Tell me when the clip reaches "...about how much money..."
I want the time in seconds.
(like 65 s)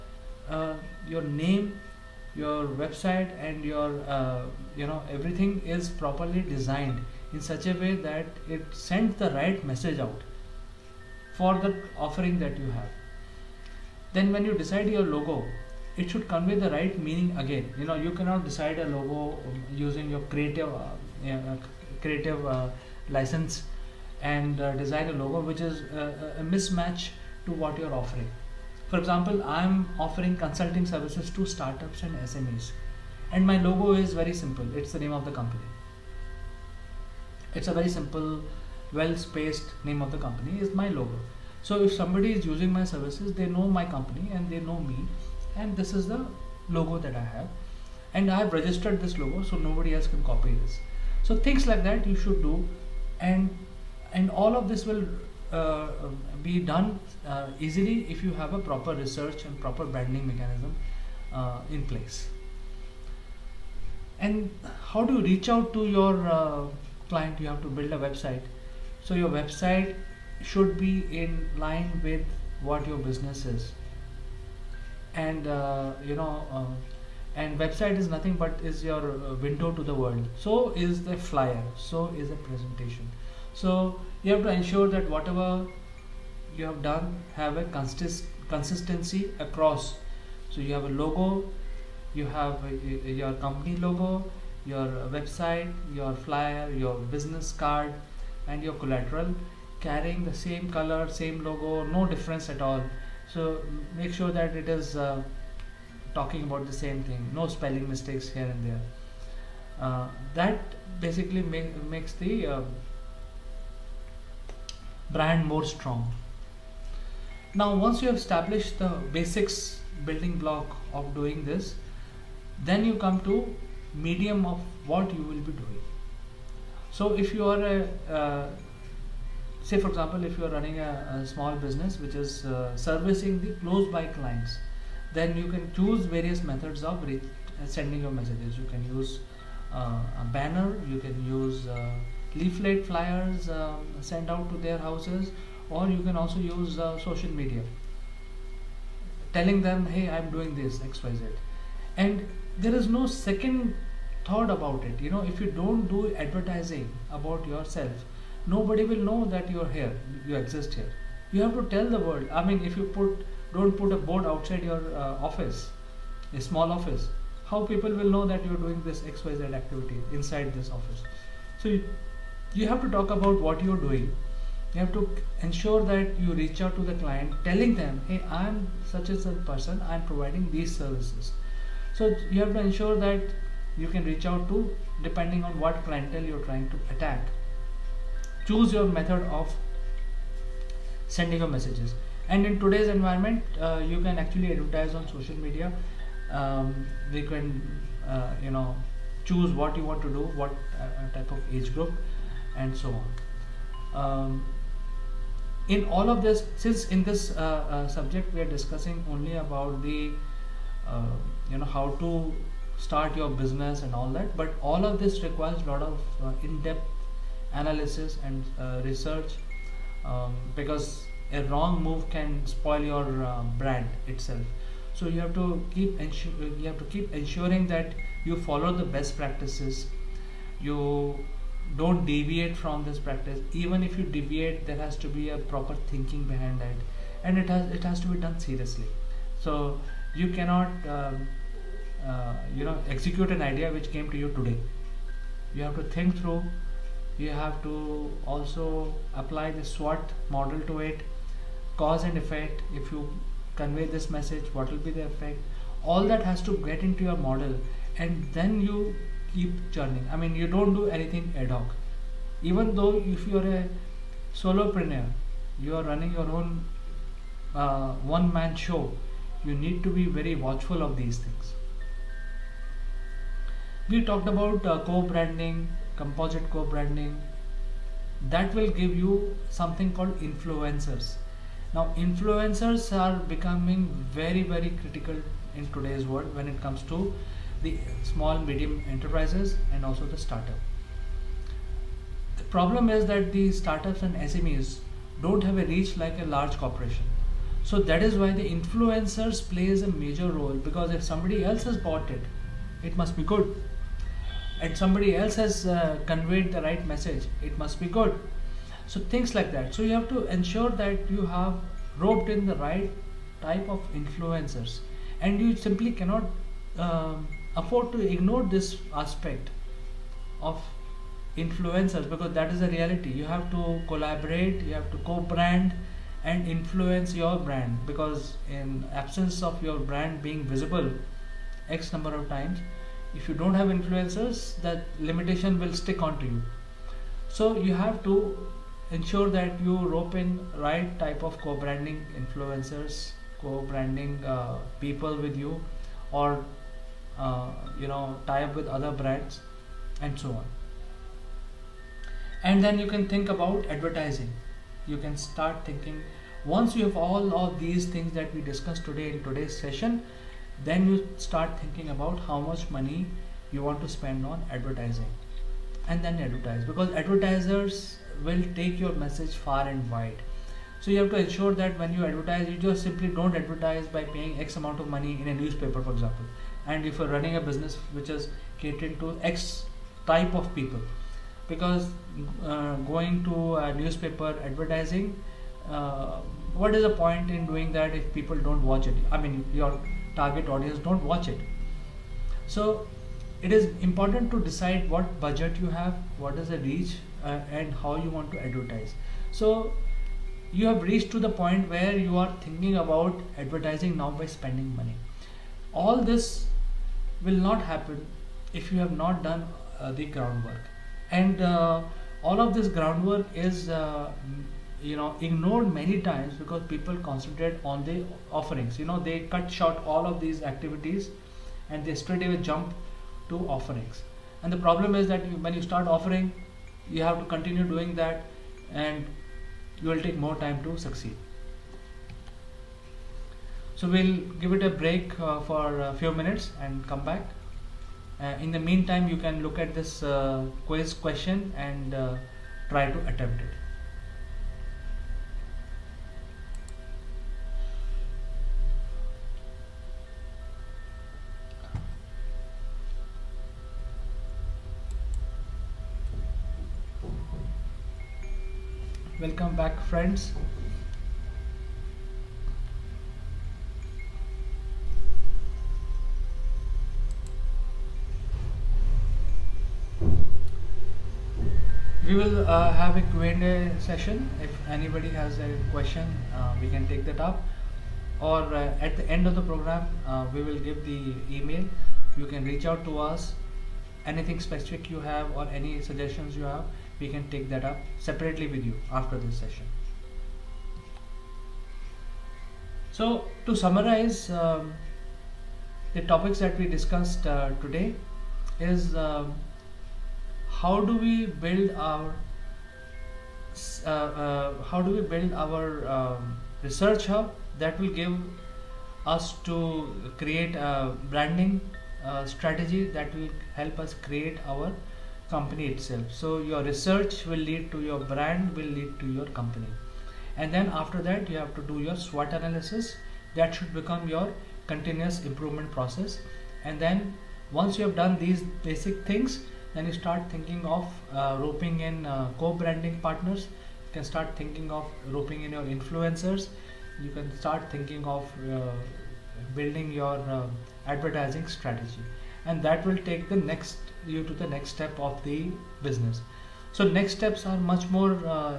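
361 s.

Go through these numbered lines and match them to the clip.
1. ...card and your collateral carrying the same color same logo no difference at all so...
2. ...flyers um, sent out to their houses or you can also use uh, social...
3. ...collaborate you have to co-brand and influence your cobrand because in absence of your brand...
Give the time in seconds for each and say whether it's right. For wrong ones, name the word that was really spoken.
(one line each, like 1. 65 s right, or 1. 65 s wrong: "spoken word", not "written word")
1. 97 s right
2. 142 s right
3. 323 s wrong: "brand", not "cobrand".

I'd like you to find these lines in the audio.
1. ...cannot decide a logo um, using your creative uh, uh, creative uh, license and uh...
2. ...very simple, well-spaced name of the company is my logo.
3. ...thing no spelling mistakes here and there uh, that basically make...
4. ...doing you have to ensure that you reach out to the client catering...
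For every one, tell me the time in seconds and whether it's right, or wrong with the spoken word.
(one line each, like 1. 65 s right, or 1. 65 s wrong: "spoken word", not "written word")
1. 18 s right
2. 37 s right
3. 107 s right
4. 173 s wrong: "telling", not "catering".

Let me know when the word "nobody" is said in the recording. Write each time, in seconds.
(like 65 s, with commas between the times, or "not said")
49 s, 158 s.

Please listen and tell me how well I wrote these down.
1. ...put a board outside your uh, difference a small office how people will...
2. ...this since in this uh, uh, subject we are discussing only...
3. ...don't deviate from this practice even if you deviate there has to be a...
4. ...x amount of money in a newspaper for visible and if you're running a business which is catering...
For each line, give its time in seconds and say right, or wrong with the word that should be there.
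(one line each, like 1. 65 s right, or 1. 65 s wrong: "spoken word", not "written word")
1. 163 s wrong: "office", not "difference"
2. 206 s right
3. 231 s right
4. 374 s wrong: "example", not "visible".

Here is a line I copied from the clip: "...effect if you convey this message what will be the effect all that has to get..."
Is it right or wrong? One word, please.
right.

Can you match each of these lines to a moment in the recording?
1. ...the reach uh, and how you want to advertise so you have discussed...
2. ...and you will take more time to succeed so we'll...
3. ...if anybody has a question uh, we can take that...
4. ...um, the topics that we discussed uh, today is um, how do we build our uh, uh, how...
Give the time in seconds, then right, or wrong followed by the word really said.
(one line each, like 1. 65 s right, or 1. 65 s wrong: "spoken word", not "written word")
1. 396 s wrong: "reached", not "discussed"
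2. 428 s right
3. 474 s right
4. 494 s right.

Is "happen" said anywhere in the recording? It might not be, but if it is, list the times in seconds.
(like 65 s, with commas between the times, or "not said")
407 s.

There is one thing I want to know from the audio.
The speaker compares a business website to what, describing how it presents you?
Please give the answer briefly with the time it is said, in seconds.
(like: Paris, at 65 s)
Window to the world, at 79 s.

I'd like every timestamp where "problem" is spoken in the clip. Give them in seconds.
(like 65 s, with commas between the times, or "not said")
292 s, 424 s.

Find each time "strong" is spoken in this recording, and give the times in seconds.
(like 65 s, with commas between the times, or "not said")
115 s.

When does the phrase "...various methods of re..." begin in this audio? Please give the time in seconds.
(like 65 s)
136 s.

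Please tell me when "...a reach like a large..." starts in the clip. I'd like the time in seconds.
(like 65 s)
295 s.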